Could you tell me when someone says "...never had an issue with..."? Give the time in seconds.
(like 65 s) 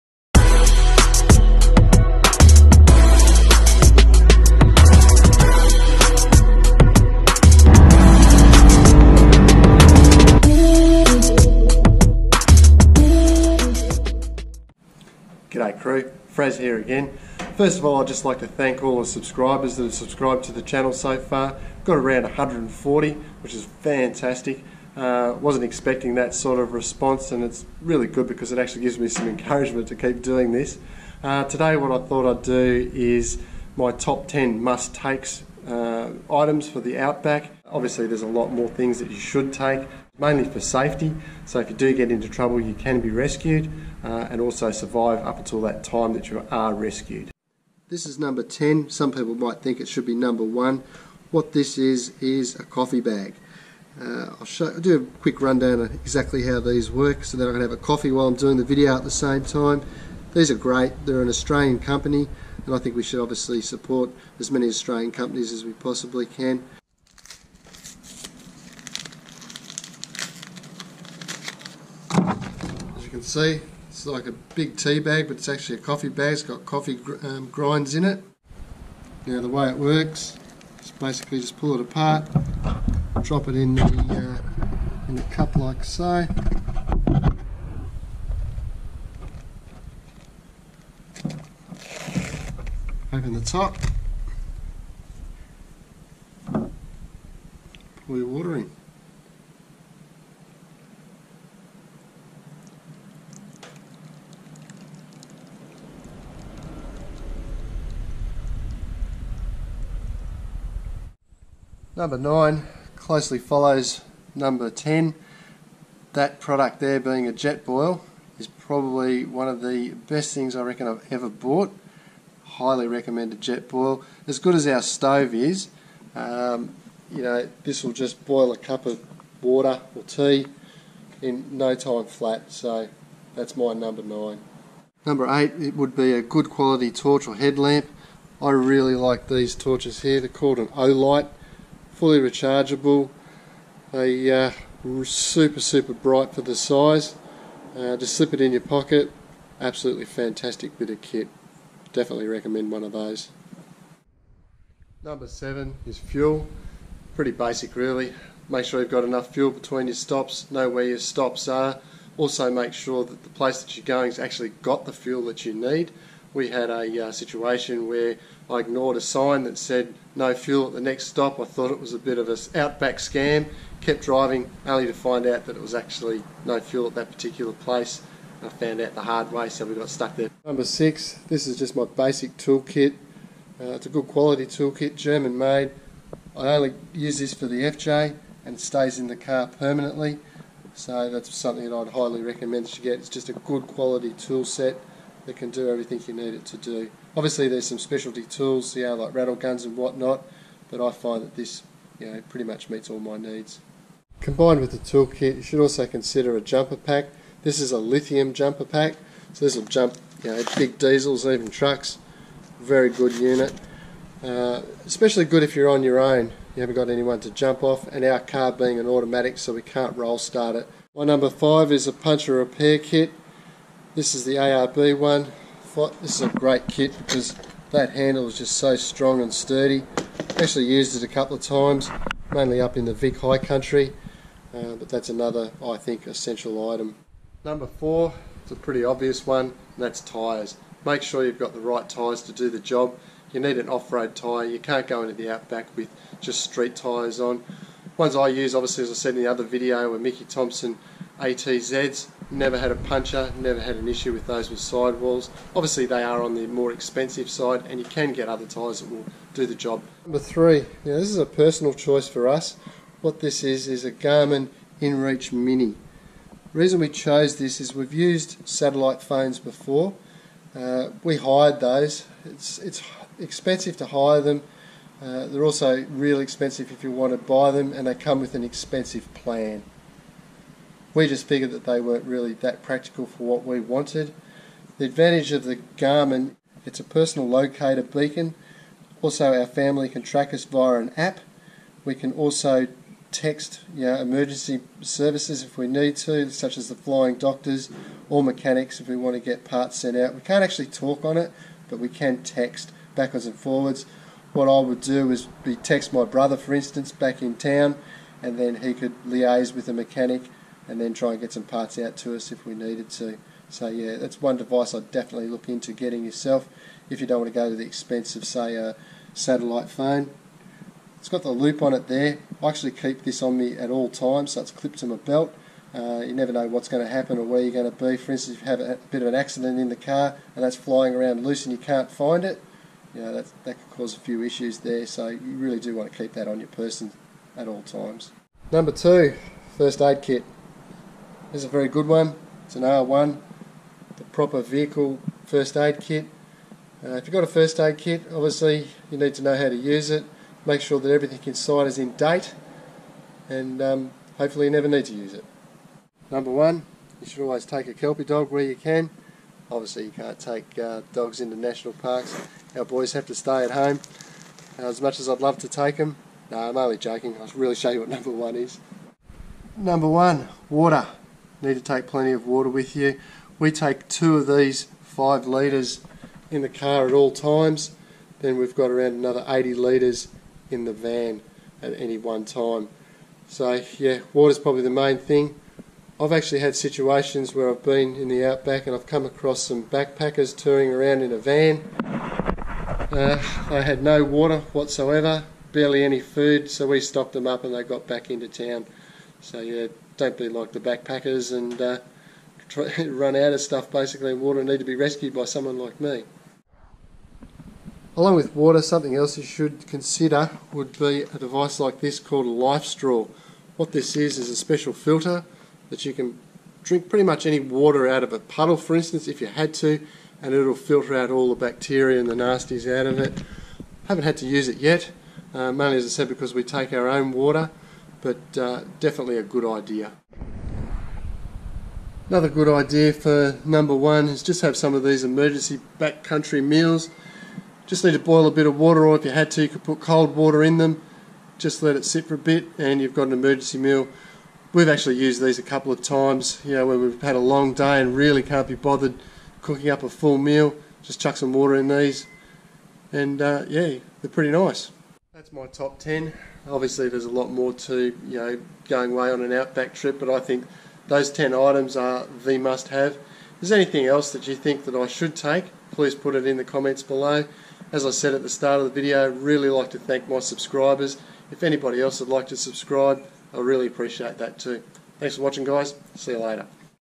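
253 s.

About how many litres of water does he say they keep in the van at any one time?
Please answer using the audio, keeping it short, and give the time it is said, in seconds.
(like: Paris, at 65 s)
80 litres, at 379 s.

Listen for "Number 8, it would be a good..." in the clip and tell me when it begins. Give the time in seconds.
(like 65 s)
135 s.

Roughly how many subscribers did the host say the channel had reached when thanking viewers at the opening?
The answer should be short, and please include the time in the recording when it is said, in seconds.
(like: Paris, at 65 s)
140, at 22 s.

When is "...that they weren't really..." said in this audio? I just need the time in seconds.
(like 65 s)
281 s.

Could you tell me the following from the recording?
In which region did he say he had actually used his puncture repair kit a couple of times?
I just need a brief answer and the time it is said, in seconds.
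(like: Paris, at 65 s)
Vic High Country, at 232 s.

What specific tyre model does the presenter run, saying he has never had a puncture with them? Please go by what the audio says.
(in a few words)
Mickey Thompson ATZs.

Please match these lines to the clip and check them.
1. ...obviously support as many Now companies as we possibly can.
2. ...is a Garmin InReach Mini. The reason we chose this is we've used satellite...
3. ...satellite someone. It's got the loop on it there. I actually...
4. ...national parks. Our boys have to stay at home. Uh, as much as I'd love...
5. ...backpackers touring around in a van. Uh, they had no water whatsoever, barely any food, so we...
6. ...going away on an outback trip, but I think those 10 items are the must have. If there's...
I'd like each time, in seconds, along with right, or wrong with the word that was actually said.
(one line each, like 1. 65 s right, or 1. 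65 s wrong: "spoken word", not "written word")
1. 63 s wrong: "Australian", not "Now"
2. 263 s right
3. 319 s wrong: "phone", not "someone"
4. 361 s right
5. 389 s right
6. 458 s right.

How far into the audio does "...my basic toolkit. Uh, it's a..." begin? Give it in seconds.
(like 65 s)
181 s.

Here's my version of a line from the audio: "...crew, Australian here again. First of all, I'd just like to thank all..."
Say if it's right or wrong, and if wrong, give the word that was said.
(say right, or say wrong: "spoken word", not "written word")
wrong: "Fraz", not "Australian".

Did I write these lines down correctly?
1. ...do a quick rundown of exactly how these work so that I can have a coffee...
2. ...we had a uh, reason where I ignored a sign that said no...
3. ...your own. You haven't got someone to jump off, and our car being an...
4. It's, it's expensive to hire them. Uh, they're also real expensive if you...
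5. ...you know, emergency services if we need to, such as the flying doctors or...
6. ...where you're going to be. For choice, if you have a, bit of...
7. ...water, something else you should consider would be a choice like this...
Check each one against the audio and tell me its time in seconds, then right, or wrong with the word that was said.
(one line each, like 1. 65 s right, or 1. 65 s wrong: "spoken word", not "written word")
1. 54 s right
2. 166 s wrong: "situation", not "reason"
3. 215 s wrong: "anyone", not "someone"
4. 272 s right
5. 293 s right
6. 327 s wrong: "instance", not "choice"
7. 408 s wrong: "device", not "choice".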